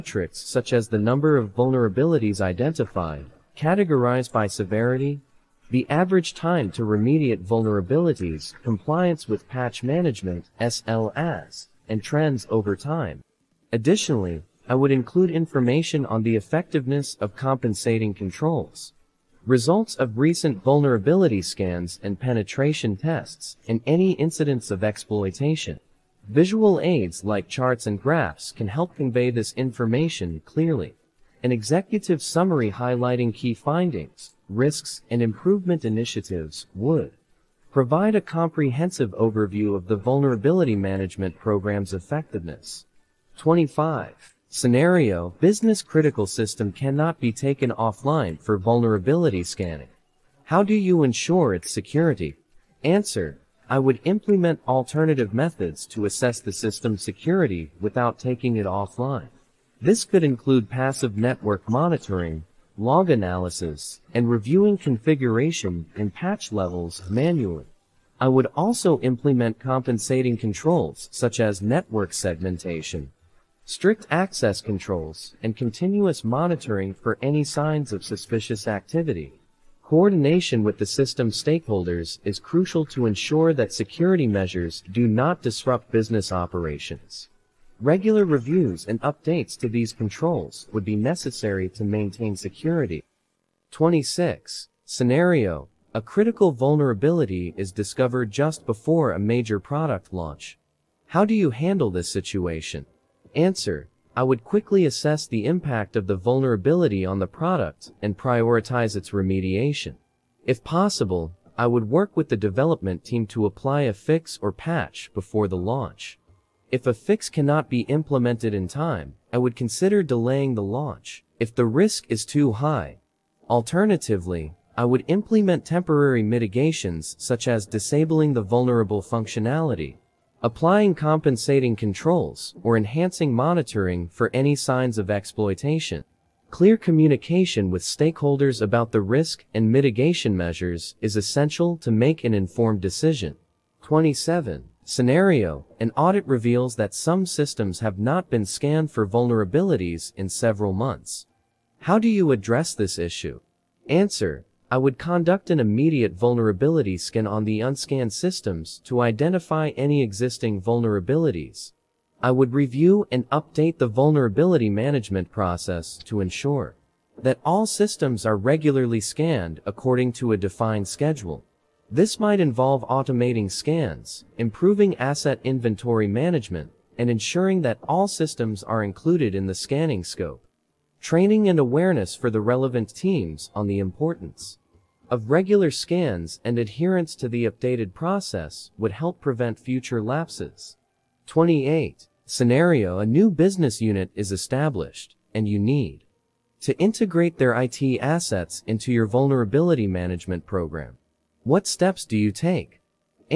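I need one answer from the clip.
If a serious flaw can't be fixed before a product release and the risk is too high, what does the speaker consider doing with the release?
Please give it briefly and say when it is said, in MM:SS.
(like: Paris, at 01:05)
delaying the launch, at 02:00.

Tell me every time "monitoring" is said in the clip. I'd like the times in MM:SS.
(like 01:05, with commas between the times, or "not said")
01:01, 01:16, 02:13.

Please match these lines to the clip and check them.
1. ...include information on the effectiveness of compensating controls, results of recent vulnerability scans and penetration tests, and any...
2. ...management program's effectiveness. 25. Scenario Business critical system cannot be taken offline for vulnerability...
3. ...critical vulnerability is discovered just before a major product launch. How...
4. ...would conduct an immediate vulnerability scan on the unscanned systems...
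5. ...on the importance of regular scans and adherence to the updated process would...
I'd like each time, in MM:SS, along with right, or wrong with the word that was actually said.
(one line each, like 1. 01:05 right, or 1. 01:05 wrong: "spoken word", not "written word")
1. 00:14 right
2. 00:40 right
3. 01:36 right
4. 02:34 right
5. 03:03 right.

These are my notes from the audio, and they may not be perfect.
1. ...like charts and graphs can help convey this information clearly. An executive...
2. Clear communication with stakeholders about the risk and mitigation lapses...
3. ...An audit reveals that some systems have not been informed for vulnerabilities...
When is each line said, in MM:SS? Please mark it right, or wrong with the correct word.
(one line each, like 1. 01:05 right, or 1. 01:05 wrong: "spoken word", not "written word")
1. 00:27 right
2. 02:16 wrong: "measures", not "lapses"
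3. 02:25 wrong: "scanned", not "informed".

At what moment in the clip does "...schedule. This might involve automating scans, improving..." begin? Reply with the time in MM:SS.
02:50.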